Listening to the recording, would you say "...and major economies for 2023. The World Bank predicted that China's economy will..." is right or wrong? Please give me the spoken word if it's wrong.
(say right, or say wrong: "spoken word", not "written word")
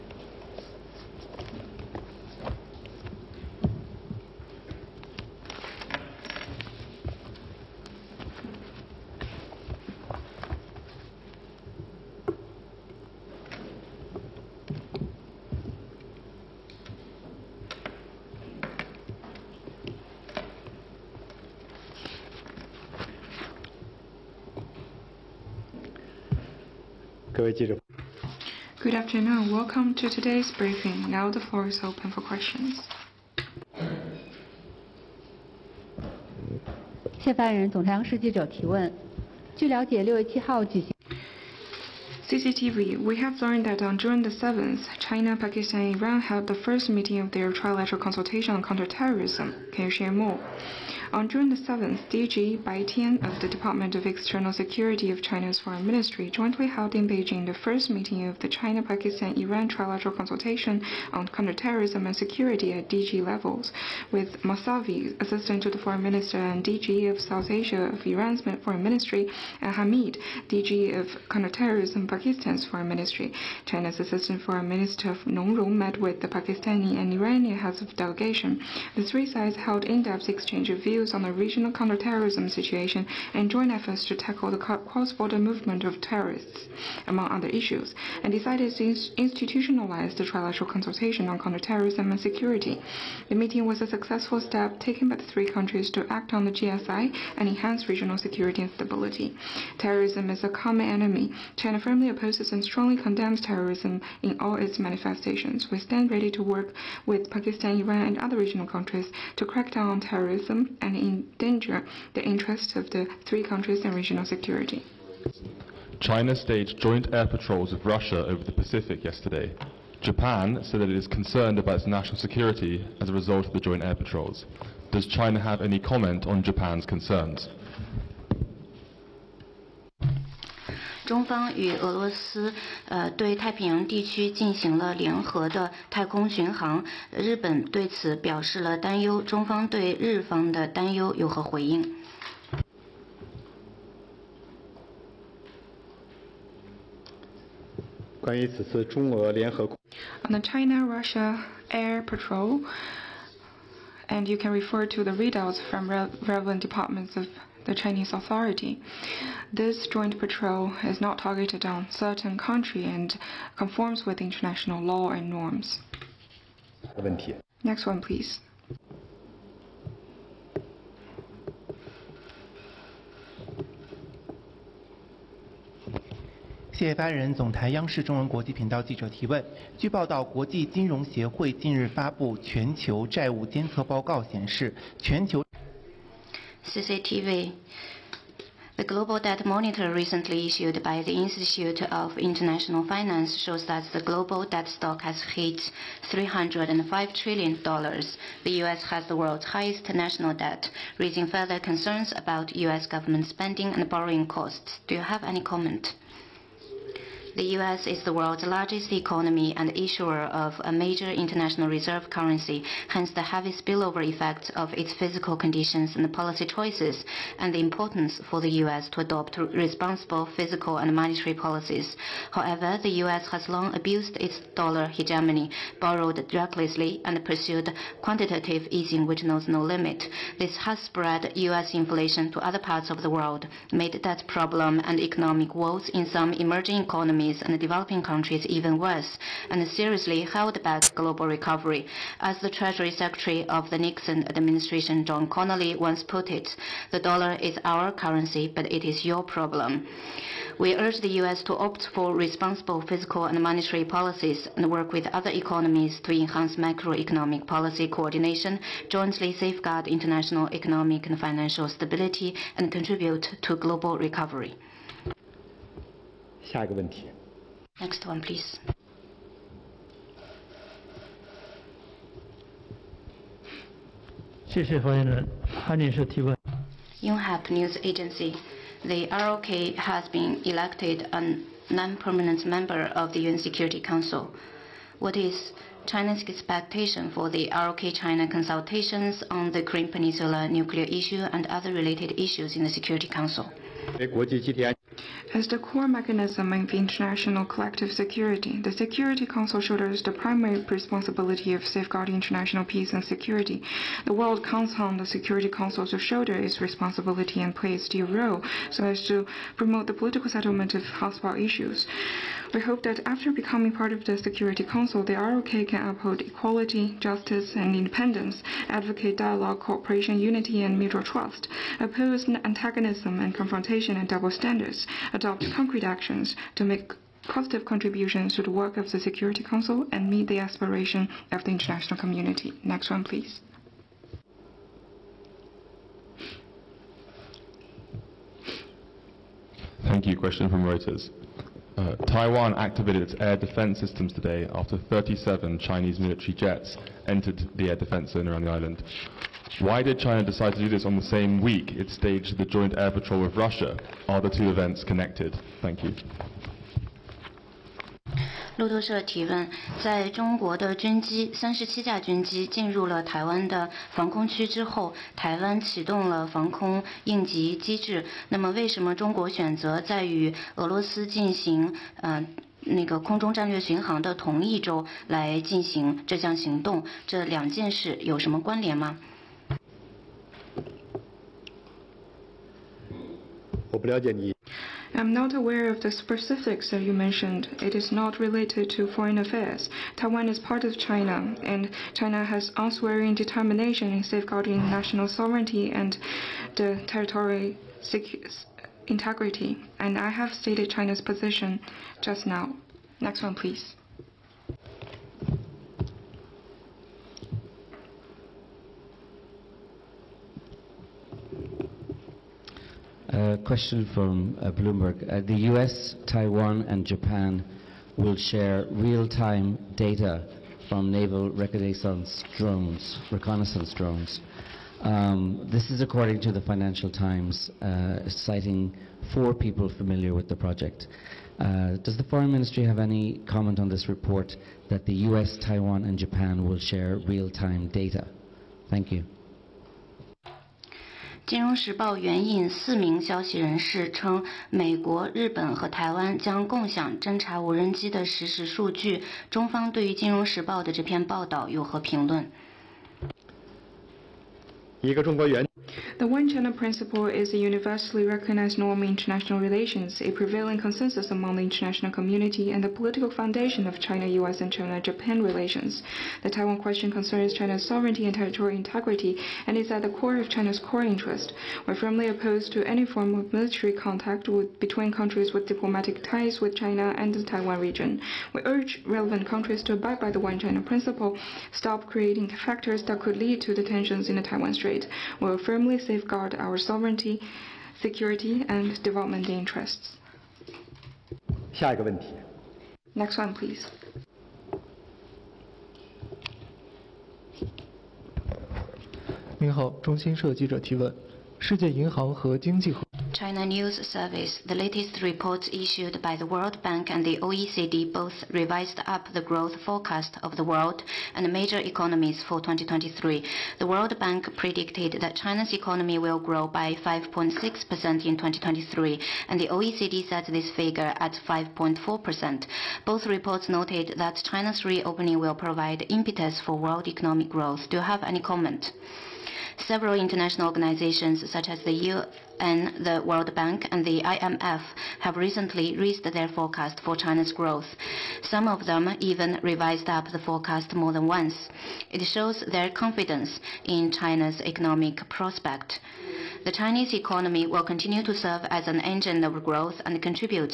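right.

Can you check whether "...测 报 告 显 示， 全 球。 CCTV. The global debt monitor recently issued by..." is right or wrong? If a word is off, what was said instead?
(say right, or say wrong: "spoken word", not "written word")
right.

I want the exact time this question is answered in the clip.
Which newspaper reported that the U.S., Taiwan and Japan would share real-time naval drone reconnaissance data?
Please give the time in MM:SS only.
07:06.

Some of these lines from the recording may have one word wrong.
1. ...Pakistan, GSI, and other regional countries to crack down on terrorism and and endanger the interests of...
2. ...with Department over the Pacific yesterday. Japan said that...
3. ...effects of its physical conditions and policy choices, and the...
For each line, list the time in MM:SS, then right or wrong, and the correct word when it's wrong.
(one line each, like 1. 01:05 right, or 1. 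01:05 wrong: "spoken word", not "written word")
1. 01:47 wrong: "Iran", not "GSI"
2. 01:57 wrong: "Russia", not "Department"
3. 03:34 right.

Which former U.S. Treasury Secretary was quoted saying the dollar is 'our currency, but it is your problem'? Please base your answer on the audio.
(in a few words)
John Connolly.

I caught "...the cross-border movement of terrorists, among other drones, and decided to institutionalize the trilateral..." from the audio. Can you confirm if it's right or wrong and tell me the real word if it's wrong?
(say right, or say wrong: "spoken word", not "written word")
wrong: "issues", not "drones".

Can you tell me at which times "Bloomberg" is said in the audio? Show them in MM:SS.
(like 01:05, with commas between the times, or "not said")
06:54.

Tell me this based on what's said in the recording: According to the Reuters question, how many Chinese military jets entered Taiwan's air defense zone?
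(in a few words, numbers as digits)
37.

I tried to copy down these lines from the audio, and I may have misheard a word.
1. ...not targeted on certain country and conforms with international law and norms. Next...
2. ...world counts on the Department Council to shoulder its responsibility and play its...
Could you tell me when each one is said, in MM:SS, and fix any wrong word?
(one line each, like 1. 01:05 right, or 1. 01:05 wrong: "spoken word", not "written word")
1. 02:41 right
2. 05:04 wrong: "Security", not "Department".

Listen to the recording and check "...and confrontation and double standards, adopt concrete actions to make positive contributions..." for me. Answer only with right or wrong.
right.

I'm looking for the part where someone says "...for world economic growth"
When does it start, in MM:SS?
08:46.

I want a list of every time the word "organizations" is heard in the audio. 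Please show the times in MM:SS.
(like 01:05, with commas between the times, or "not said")
08:50.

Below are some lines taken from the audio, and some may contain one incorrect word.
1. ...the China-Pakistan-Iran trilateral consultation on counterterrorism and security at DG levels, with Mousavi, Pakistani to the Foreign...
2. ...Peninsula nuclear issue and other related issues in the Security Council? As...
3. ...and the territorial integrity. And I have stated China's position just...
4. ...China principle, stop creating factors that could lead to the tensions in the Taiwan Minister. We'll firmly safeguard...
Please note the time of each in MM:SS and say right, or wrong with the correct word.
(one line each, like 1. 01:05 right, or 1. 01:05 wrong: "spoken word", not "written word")
1. 00:58 wrong: "Assistant", not "Pakistani"
2. 04:49 right
3. 06:35 right
4. 08:00 wrong: "Strait", not "Minister".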